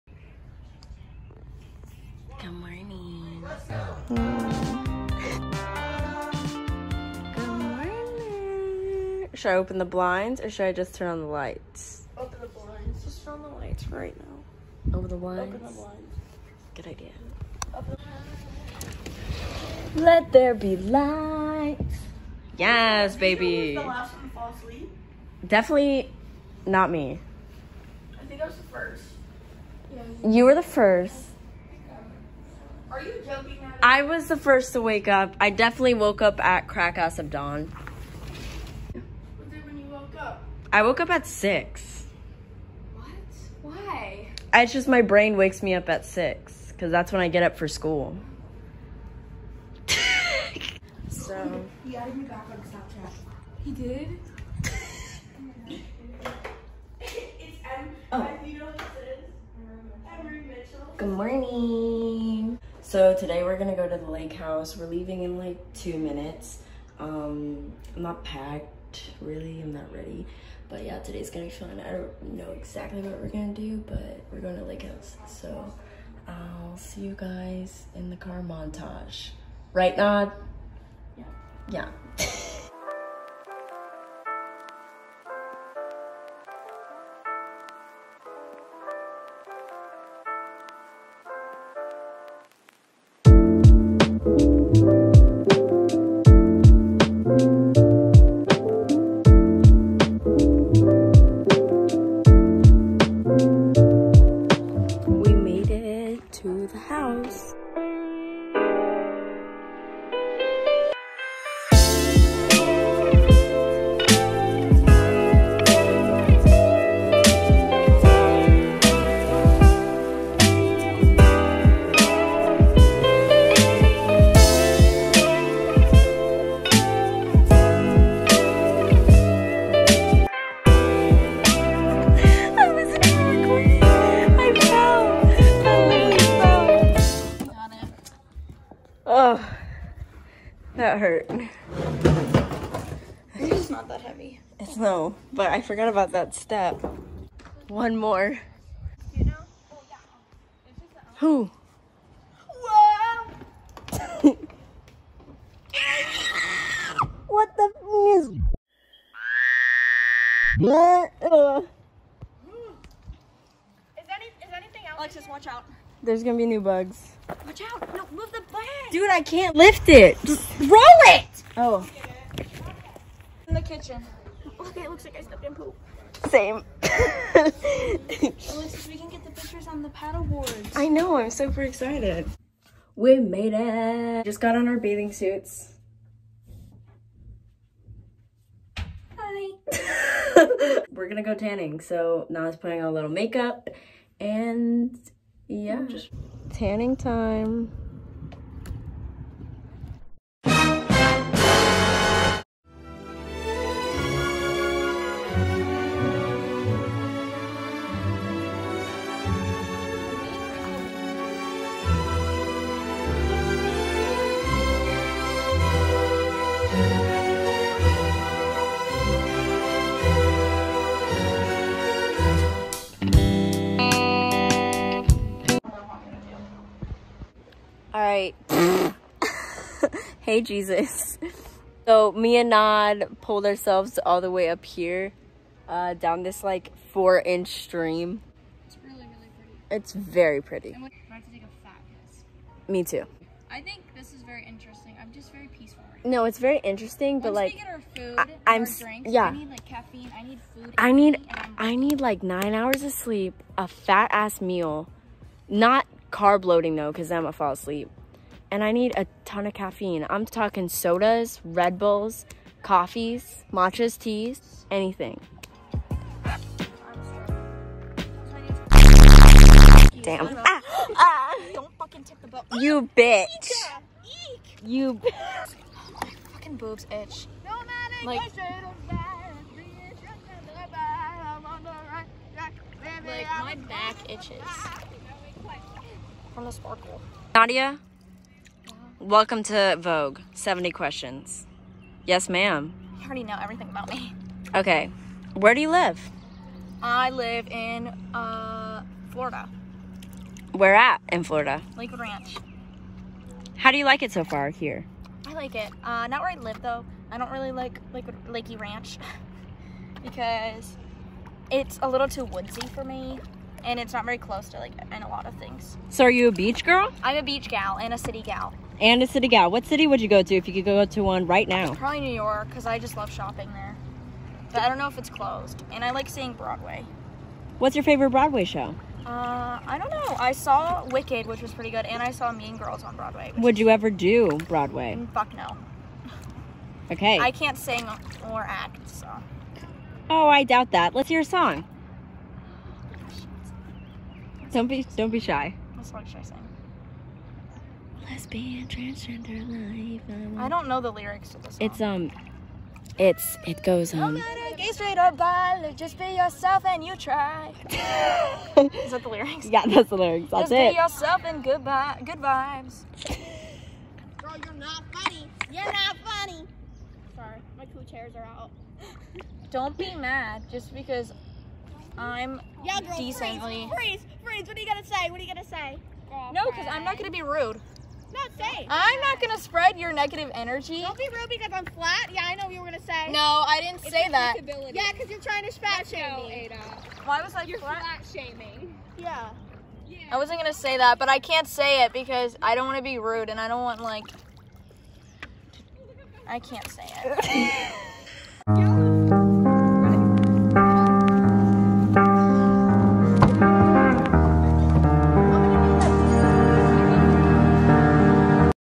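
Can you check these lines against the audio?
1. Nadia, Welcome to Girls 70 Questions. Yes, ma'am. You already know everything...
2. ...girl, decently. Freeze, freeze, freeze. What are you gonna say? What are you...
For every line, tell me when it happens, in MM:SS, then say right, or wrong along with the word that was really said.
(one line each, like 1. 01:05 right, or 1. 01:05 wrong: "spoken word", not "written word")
1. 04:47 wrong: "Vogue", not "Girls"
2. 06:12 right.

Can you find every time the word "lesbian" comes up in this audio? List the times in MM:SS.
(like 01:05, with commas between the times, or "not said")
05:48.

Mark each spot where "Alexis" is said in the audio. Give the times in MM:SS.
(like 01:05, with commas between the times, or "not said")
02:44, 02:57.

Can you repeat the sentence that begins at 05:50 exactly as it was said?
I, uh, I don't know the lyrics to this.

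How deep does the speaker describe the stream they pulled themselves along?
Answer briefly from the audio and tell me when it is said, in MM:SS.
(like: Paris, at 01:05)
4 inches, at 03:56.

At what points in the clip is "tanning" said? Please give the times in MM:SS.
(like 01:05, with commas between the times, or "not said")
03:11, 03:16.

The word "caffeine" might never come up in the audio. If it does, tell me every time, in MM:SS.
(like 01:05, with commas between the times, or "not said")
04:09, 04:19.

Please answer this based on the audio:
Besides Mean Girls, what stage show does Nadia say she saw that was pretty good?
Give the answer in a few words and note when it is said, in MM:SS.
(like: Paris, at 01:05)
Wicked, at 05:30.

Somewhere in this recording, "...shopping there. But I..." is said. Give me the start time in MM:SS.
05:23.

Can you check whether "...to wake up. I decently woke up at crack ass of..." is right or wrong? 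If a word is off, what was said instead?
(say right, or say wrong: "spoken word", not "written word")
wrong: "definitely", not "decently".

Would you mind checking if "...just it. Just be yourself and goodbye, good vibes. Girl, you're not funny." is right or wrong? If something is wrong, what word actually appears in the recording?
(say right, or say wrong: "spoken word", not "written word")
right.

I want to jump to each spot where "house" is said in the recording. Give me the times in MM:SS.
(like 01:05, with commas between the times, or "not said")
01:04, 01:14.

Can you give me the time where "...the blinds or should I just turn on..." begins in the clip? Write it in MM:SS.
00:09.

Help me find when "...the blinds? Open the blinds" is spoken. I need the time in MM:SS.
00:15.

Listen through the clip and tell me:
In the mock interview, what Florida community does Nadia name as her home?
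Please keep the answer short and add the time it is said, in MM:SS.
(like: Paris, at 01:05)
Lakewood Ranch, at 05:01.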